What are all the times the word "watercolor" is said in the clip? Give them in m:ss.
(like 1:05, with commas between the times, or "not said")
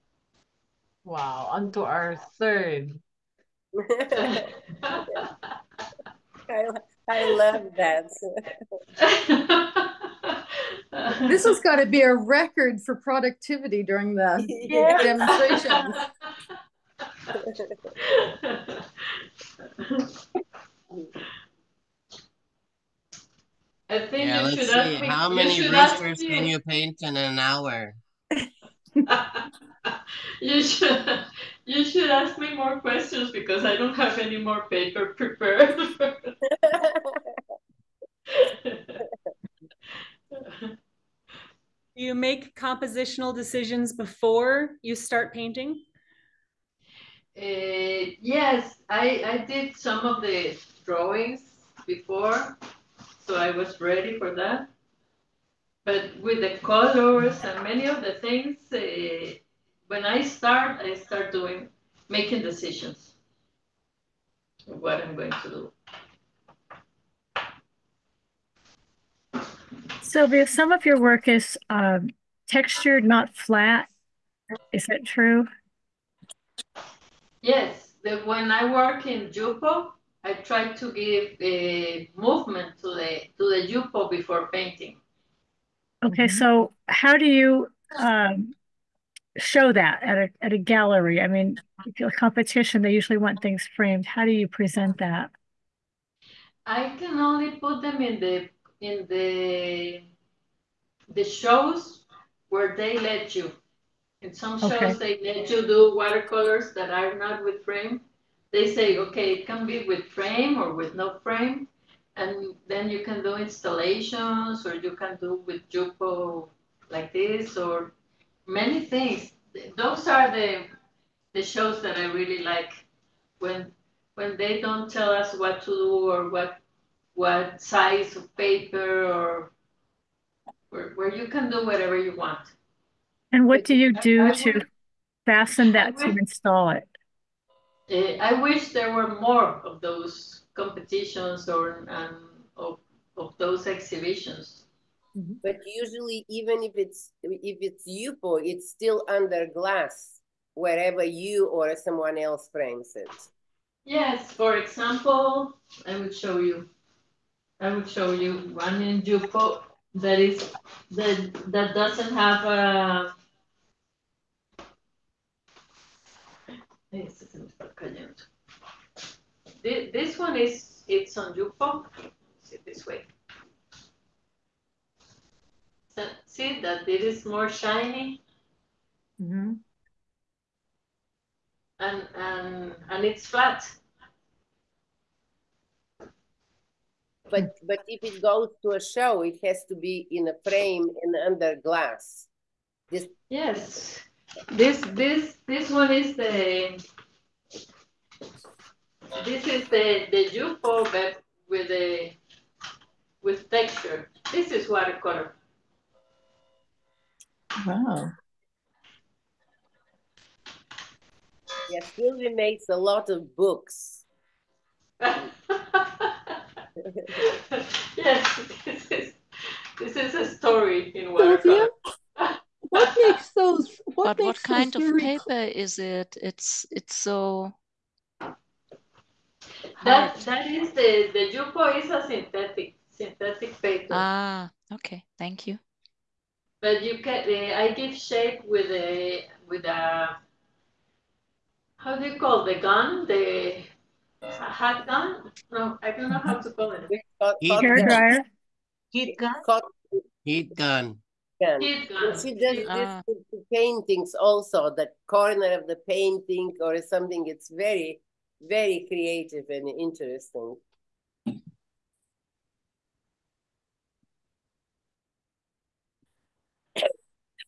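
1:45, 3:24, 3:41.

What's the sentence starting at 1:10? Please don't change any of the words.
Silvia, some of your work is uh, textured, not flat.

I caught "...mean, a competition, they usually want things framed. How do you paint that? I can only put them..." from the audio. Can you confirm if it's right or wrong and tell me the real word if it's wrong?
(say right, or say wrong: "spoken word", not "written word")
wrong: "present", not "paint".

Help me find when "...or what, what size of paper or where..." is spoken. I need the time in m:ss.
2:06.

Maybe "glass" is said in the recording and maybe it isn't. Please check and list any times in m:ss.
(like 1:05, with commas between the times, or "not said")
2:29, 3:11.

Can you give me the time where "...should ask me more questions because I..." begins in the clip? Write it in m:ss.
0:31.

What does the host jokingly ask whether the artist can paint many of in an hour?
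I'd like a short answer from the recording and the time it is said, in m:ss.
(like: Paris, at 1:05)
Roosters, at 0:25.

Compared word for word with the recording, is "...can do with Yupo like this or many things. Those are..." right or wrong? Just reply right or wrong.
right.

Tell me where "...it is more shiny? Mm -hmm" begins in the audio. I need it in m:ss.
2:56.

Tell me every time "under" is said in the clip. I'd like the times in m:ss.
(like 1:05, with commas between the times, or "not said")
2:29, 3:11.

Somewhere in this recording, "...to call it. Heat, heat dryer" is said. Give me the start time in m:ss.
4:06.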